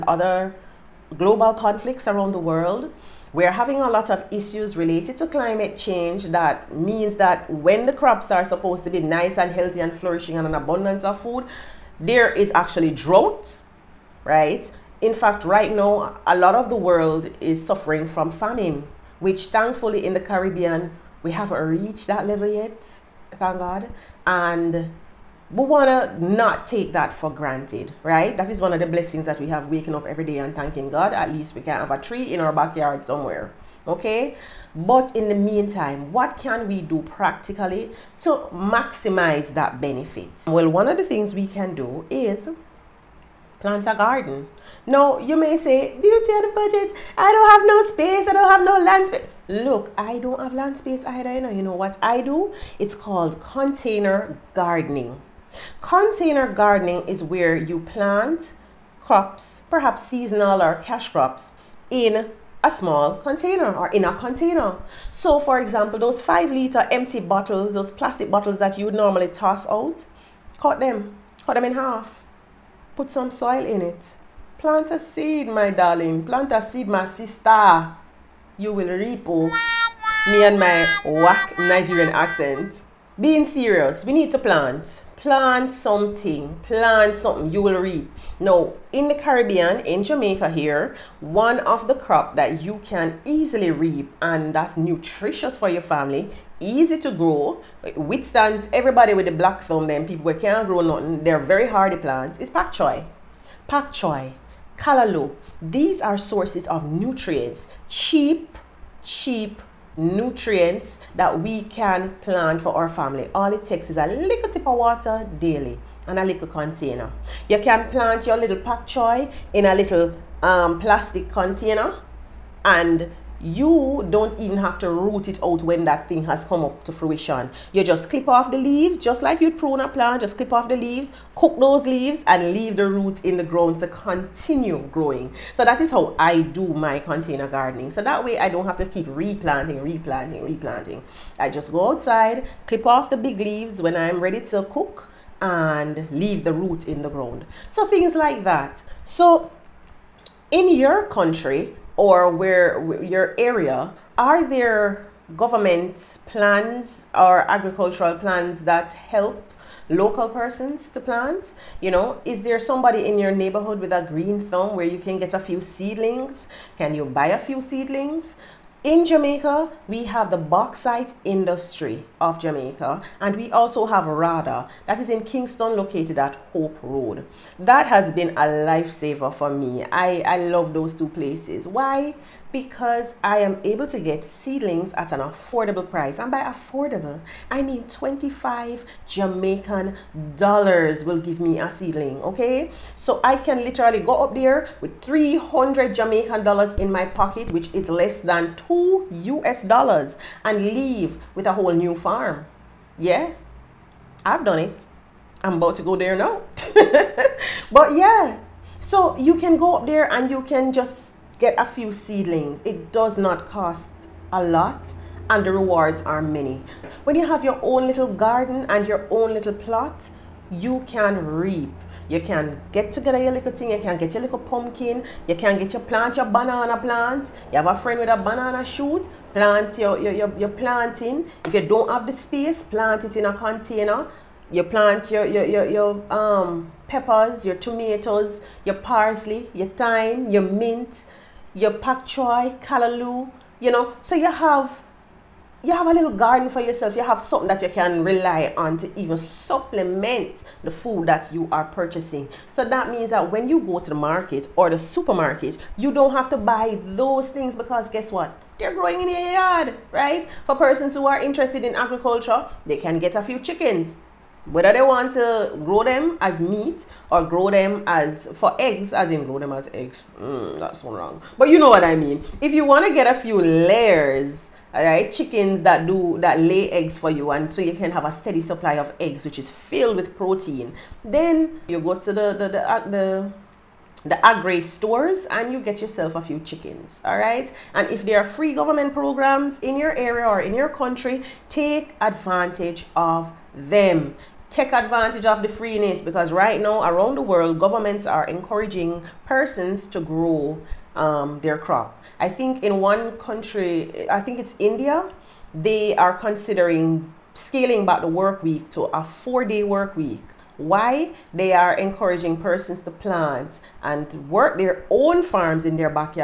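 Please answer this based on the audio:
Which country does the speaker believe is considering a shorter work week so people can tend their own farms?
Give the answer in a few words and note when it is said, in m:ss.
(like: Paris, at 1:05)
India, at 5:04.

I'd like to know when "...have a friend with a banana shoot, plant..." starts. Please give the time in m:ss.
3:47.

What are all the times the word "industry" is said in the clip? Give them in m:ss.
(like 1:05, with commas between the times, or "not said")
2:51.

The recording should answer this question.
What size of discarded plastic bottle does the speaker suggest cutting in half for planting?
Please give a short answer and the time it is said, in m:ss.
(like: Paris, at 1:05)
5 liter, at 1:06.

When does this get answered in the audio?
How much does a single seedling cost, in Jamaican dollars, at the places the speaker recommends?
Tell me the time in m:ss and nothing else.
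3:07.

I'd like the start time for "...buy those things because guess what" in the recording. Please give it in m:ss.
4:16.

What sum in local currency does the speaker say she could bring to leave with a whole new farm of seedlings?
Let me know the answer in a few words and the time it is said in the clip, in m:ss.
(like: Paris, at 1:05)
300 Jamaican dollars, at 3:15.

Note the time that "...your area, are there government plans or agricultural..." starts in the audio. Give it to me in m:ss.
2:33.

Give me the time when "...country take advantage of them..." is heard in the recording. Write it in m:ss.
4:50.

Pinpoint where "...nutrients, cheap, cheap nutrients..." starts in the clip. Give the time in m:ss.
1:46.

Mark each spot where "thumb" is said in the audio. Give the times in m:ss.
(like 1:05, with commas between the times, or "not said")
1:39, 2:44.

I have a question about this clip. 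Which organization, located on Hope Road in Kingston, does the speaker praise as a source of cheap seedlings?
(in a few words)
RADA.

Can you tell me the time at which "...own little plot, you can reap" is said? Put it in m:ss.
3:39.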